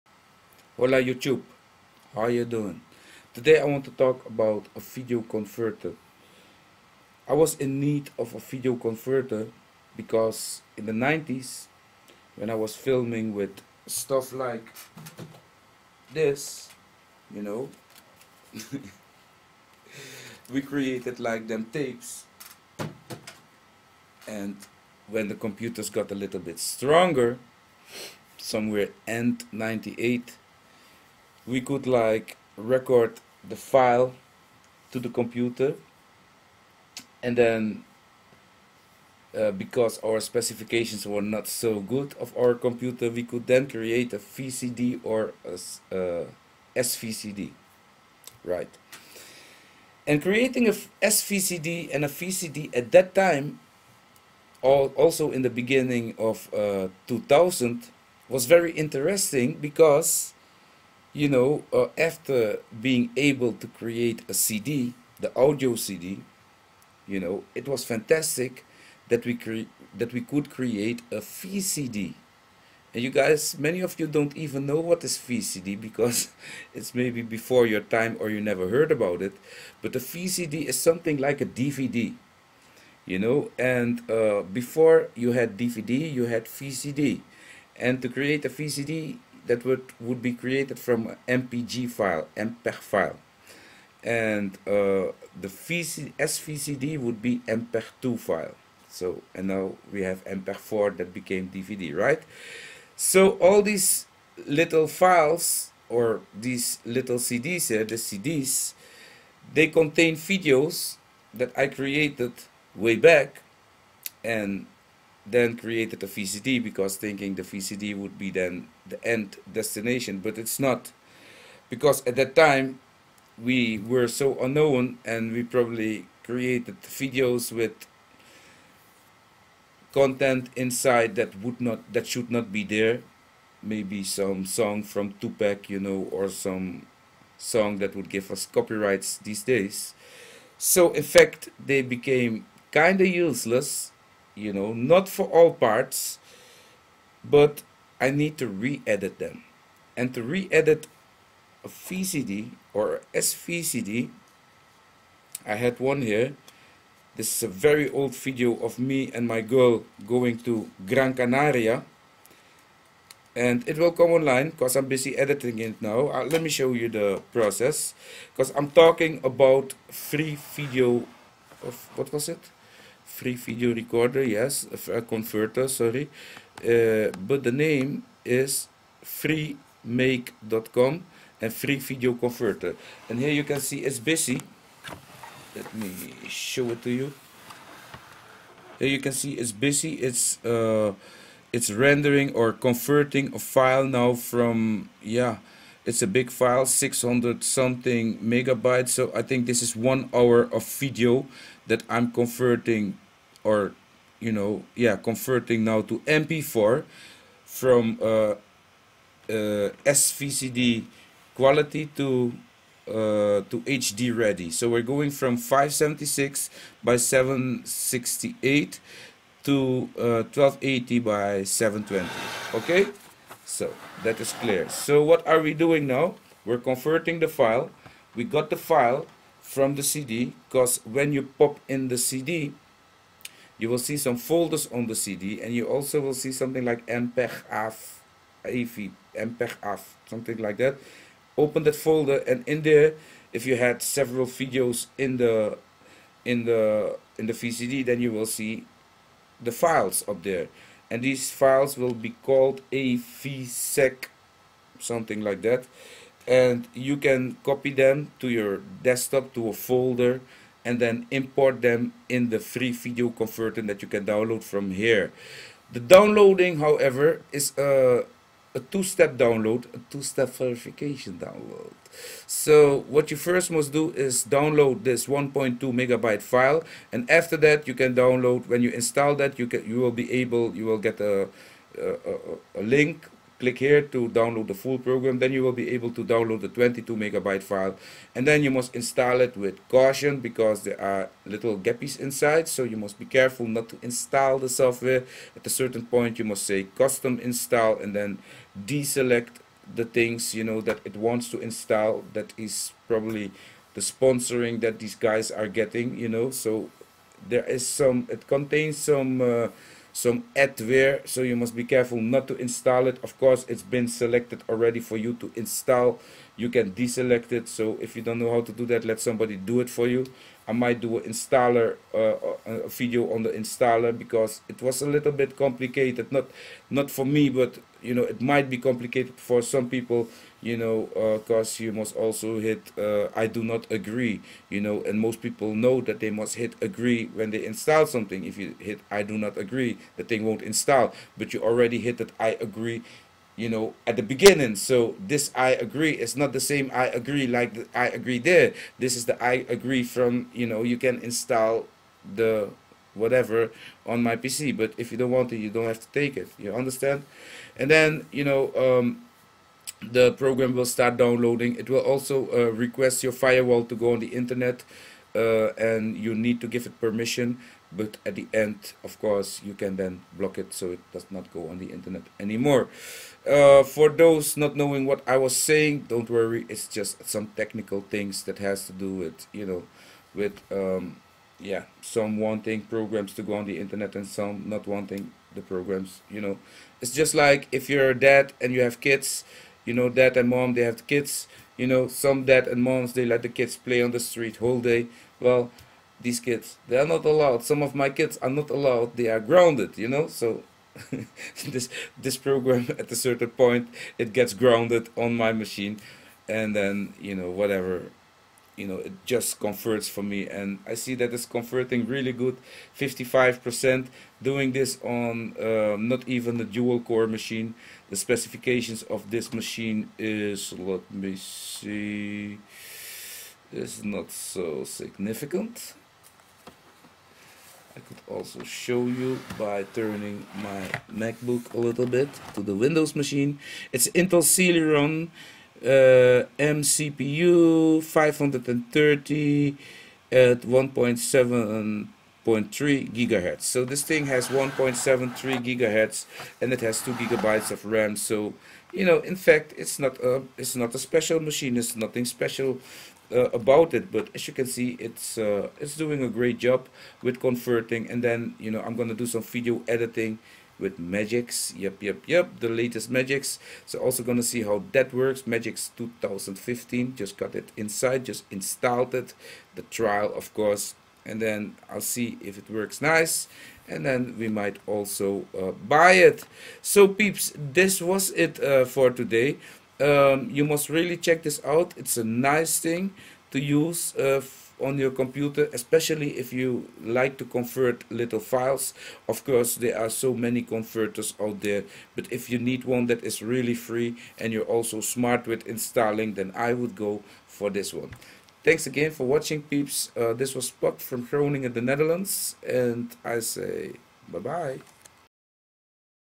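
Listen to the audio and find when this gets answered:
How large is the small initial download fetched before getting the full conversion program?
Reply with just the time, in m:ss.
4:35.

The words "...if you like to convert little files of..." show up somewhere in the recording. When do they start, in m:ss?
8:06.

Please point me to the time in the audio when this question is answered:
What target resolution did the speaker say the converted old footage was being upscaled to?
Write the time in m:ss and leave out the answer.
3:39.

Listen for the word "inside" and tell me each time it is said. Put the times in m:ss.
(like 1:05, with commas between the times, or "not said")
2:10, 4:51, 7:47.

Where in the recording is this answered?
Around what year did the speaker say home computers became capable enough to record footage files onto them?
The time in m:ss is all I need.
0:29.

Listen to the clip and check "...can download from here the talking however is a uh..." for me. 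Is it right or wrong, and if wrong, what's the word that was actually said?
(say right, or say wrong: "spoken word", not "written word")
wrong: "downloading", not "talking".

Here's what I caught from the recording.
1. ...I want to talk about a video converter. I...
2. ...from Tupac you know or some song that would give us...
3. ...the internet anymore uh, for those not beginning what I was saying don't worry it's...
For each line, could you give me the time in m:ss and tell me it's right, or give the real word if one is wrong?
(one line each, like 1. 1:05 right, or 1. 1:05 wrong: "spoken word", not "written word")
1. 0:03 right
2. 2:14 right
3. 6:11 wrong: "knowing", not "beginning".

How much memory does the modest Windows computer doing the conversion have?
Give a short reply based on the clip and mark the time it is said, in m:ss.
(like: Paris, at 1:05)
2 gigabytes, at 7:26.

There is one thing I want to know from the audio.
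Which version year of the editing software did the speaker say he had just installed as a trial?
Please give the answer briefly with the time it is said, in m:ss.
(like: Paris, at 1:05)
2015, at 7:45.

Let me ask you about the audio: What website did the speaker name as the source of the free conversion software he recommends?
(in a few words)
freemake.com.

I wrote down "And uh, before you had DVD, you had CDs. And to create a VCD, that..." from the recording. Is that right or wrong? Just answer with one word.
wrong.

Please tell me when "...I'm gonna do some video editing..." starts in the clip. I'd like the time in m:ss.
7:38.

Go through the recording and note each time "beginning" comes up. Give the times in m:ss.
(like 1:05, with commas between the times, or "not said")
0:55, 5:44.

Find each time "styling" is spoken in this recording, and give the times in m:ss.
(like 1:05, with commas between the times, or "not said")
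not said.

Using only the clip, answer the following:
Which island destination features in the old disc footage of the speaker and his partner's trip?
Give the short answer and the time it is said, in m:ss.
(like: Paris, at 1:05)
Gran Canaria, at 2:40.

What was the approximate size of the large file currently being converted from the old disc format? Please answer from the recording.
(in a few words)
600 megabytes.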